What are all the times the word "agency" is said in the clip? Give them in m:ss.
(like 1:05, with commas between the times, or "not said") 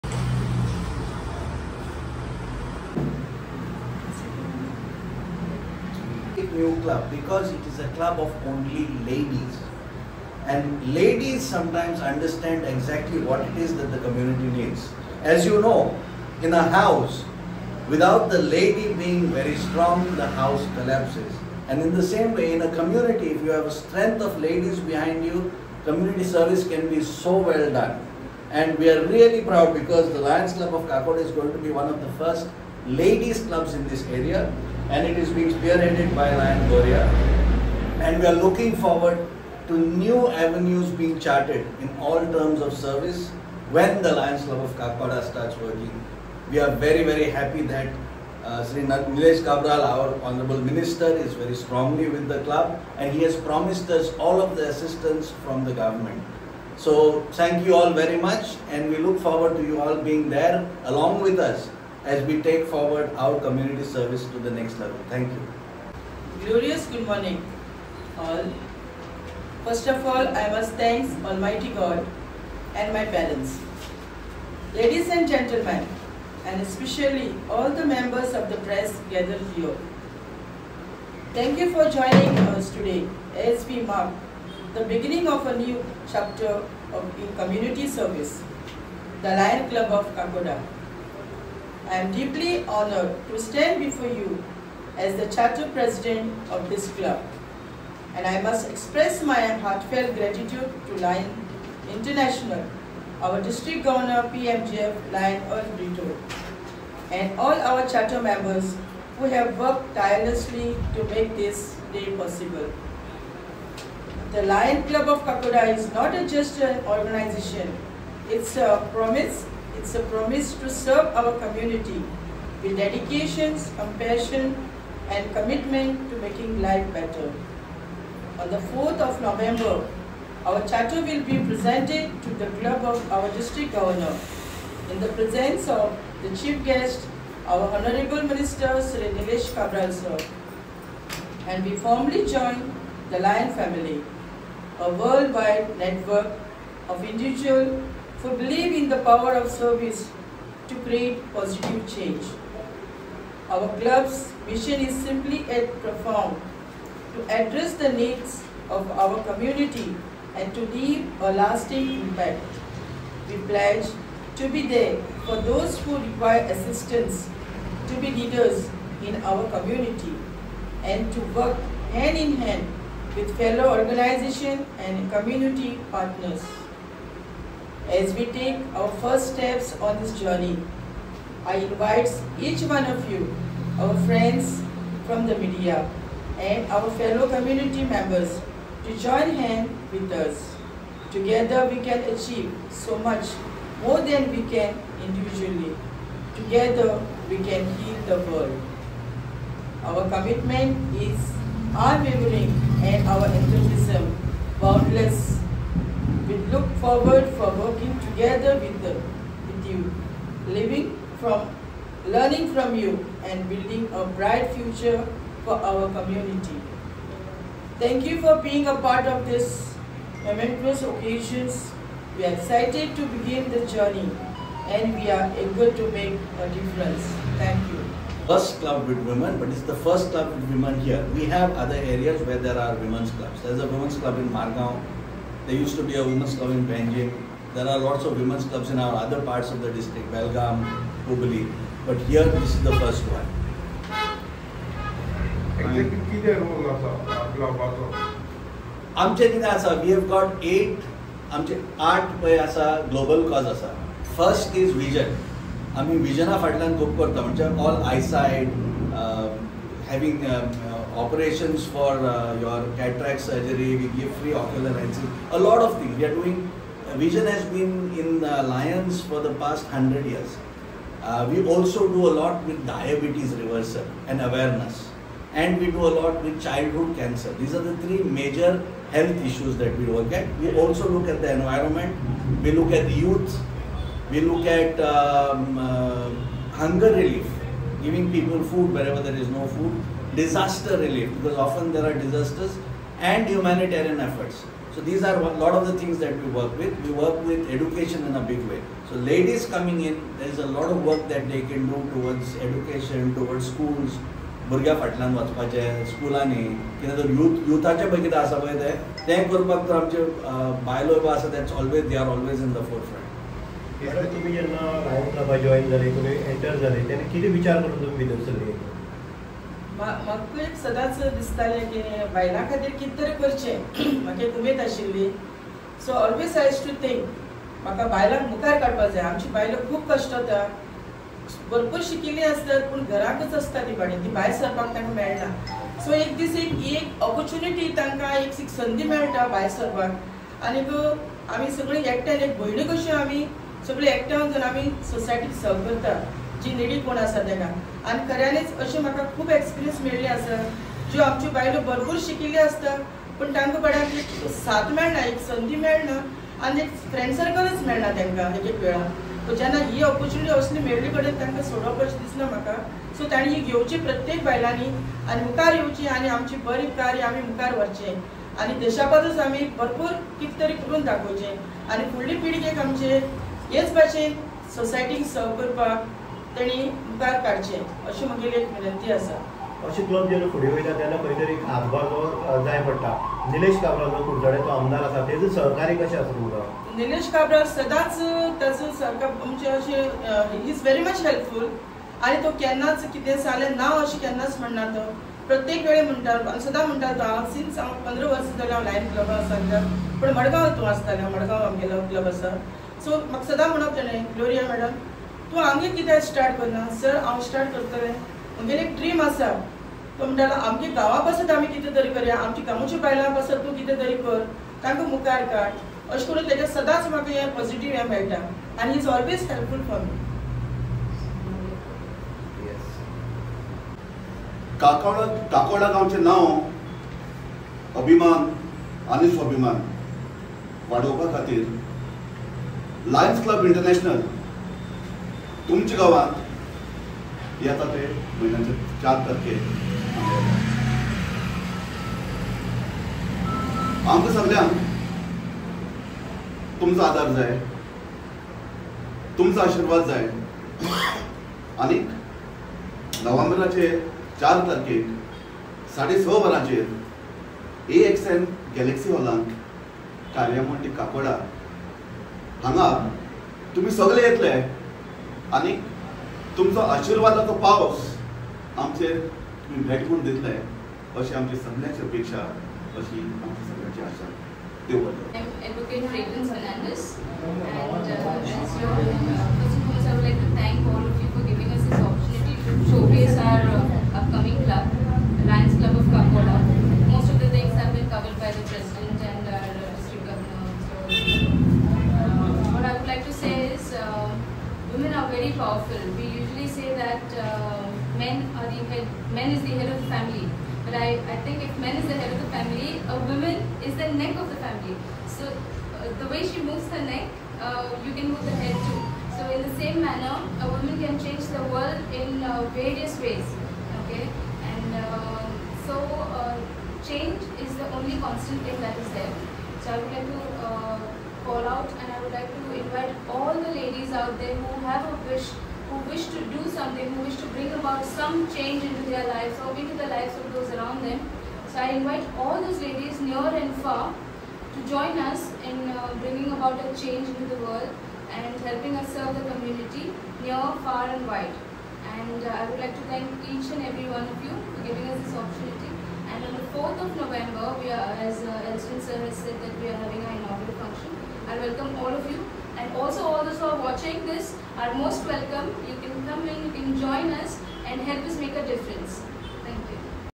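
not said.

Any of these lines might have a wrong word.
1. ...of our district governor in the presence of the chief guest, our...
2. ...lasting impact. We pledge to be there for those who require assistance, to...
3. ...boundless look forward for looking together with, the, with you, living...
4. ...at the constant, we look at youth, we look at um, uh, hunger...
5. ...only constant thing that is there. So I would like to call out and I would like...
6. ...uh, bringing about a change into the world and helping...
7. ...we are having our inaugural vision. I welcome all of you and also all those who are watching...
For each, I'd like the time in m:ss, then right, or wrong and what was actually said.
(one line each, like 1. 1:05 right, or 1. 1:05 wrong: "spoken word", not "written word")
1. 2:12 right
2. 2:41 right
3. 3:24 wrong: "working", not "looking"
4. 4:41 wrong: "environment", not "constant"
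5. 8:37 right
6. 8:55 right
7. 9:09 wrong: "function", not "vision".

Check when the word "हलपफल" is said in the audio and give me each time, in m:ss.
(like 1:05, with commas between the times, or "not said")
6:31, 6:59.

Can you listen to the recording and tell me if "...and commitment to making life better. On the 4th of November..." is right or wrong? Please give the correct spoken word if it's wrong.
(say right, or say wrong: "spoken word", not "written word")
right.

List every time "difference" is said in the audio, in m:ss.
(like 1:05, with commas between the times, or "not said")
3:46, 9:18.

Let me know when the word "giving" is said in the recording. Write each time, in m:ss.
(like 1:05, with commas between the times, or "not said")
4:47, 9:04.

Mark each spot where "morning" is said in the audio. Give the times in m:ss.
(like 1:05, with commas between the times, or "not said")
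1:07.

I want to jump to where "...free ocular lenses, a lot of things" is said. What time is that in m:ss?
4:24.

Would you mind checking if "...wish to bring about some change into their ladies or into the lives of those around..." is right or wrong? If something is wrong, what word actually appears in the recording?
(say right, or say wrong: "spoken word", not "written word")
wrong: "lives", not "ladies".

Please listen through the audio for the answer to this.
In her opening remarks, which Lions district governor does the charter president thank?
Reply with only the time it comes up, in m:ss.
1:45.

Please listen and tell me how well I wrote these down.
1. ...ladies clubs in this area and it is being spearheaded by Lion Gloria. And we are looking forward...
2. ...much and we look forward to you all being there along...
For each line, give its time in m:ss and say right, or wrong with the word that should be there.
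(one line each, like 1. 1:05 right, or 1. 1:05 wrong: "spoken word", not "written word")
1. 0:33 right
2. 0:58 right.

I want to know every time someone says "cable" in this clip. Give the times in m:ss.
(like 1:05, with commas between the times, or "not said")
not said.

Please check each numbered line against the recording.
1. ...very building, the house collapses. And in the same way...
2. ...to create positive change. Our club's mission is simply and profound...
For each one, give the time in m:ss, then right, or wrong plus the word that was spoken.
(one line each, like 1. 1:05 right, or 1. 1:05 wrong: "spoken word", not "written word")
1. 0:19 wrong: "strong", not "building"
2. 2:30 right.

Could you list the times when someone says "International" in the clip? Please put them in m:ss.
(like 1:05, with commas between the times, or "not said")
1:41.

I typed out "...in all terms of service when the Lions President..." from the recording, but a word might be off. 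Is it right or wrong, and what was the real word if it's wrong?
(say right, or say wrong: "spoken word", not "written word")
wrong: "Club", not "President".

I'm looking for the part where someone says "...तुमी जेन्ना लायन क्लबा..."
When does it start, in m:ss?
5:14.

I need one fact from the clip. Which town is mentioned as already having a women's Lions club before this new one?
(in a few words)
Margao.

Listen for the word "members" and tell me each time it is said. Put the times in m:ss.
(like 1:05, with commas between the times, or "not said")
1:17, 1:48, 3:07.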